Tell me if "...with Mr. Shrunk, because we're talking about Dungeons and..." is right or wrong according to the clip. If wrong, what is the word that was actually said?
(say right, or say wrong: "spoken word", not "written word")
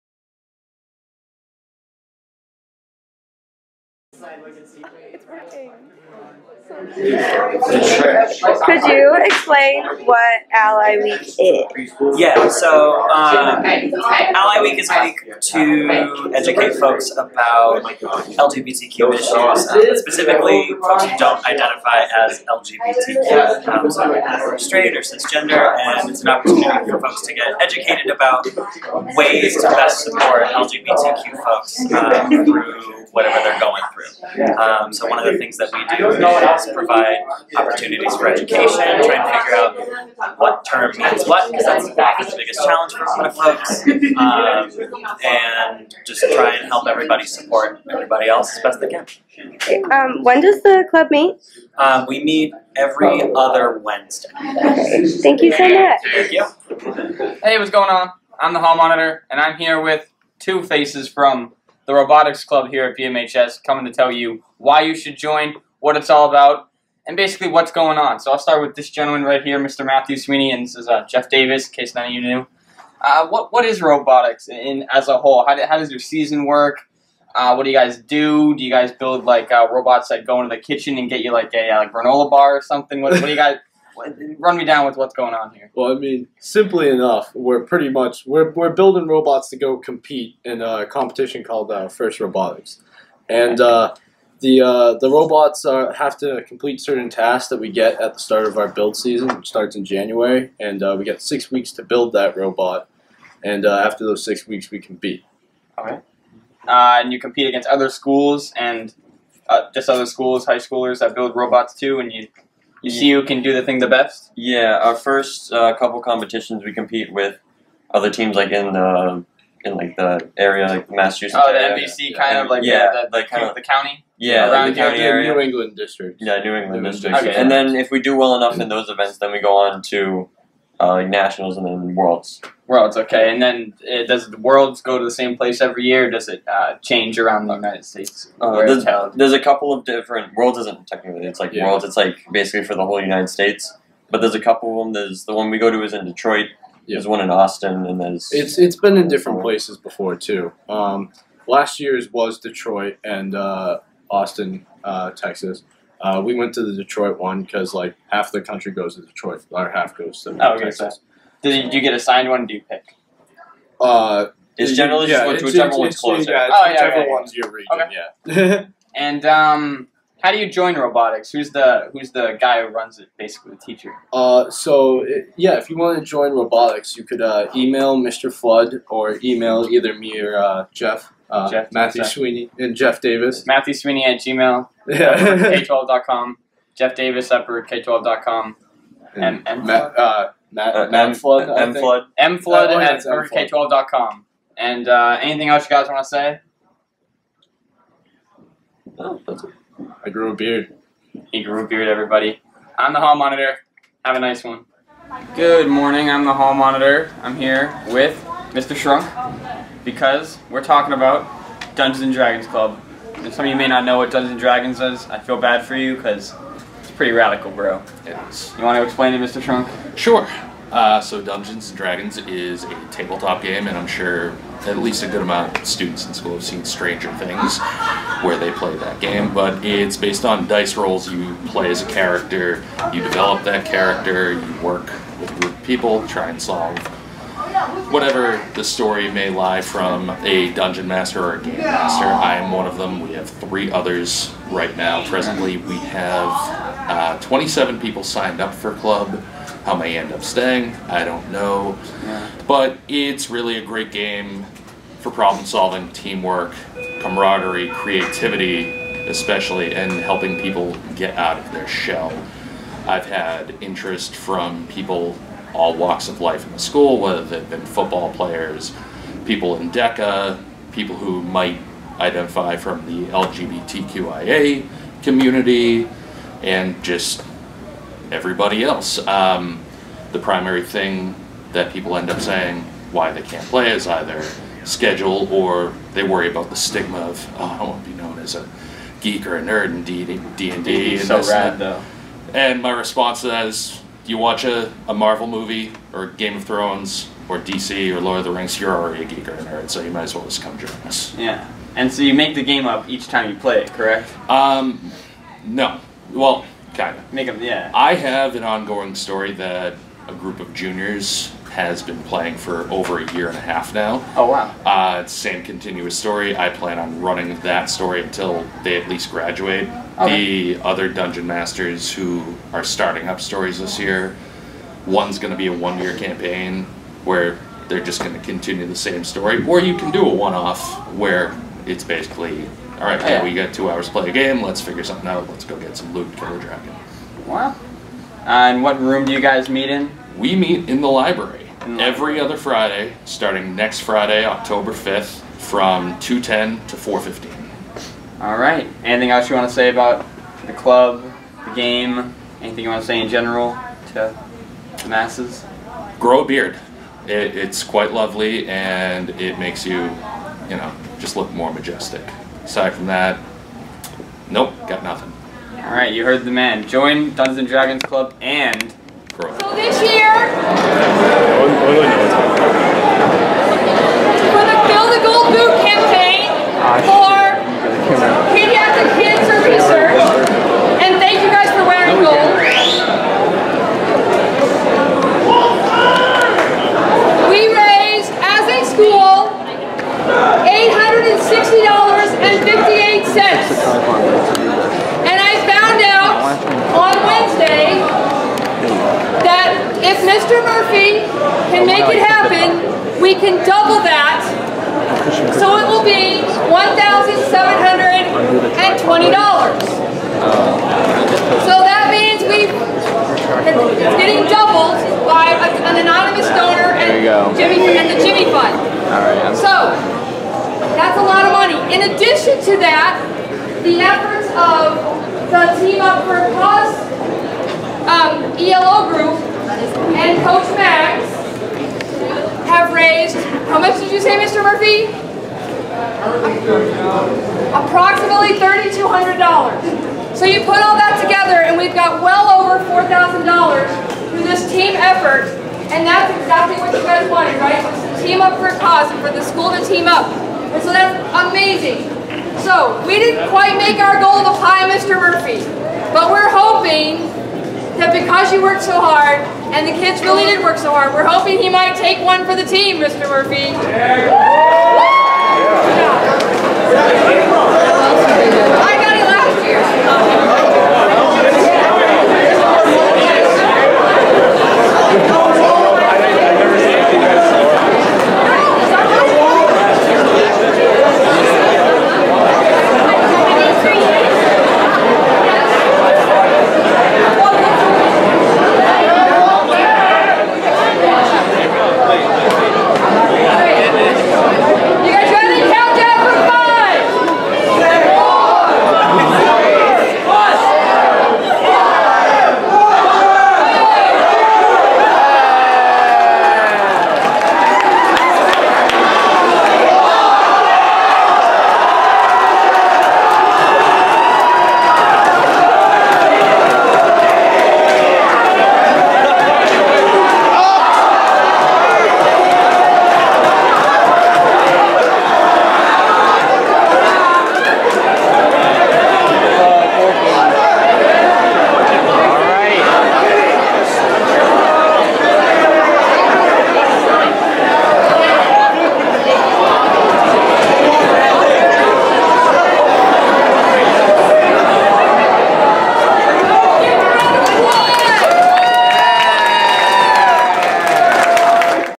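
right.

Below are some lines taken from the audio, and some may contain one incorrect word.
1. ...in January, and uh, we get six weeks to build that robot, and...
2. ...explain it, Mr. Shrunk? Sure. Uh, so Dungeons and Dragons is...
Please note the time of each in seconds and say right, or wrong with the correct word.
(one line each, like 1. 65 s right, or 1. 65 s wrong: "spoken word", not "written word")
1. 99 s right
2. 218 s right.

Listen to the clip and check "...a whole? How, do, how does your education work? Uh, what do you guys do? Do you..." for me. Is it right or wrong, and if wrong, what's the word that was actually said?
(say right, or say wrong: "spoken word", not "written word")
wrong: "season", not "education".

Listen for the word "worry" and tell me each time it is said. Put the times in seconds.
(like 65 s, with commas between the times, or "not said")
286 s.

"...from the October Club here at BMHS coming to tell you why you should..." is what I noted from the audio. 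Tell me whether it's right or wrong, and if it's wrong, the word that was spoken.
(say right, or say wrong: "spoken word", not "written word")
wrong: "Robotics", not "October".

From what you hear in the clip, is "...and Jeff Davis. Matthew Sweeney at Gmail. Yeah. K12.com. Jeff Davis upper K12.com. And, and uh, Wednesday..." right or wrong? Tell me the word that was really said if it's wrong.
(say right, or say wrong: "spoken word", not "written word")
wrong: "Matt", not "Wednesday".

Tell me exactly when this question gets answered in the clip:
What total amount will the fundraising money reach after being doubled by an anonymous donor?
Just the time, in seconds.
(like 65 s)
406 s.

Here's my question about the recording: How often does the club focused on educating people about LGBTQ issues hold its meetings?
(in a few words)
Every other Wednesday.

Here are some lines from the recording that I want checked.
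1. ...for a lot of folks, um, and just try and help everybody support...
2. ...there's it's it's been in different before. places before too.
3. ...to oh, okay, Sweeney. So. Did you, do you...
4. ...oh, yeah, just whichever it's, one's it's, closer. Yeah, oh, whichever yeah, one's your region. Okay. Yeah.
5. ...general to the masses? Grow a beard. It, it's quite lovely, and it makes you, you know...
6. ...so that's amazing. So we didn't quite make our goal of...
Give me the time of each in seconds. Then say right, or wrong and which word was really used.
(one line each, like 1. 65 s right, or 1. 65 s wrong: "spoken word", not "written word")
1. 42 s right
2. 148 s right
3. 160 s wrong: "Texas", not "Sweeney"
4. 165 s right
5. 353 s right
6. 450 s right.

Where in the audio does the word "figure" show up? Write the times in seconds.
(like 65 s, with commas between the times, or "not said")
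39 s, 334 s.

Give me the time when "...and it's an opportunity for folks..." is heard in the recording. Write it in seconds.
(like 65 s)
25 s.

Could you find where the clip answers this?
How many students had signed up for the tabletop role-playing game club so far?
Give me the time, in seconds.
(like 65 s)
247 s.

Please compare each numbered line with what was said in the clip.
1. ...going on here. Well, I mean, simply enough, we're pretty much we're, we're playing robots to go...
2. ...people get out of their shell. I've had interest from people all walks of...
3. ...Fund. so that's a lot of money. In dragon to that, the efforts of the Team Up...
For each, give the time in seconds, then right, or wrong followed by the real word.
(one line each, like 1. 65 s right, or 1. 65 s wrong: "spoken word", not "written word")
1. 85 s wrong: "building", not "playing"
2. 260 s right
3. 418 s wrong: "addition", not "dragon".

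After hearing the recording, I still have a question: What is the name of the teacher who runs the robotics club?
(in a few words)
Mr. Flood.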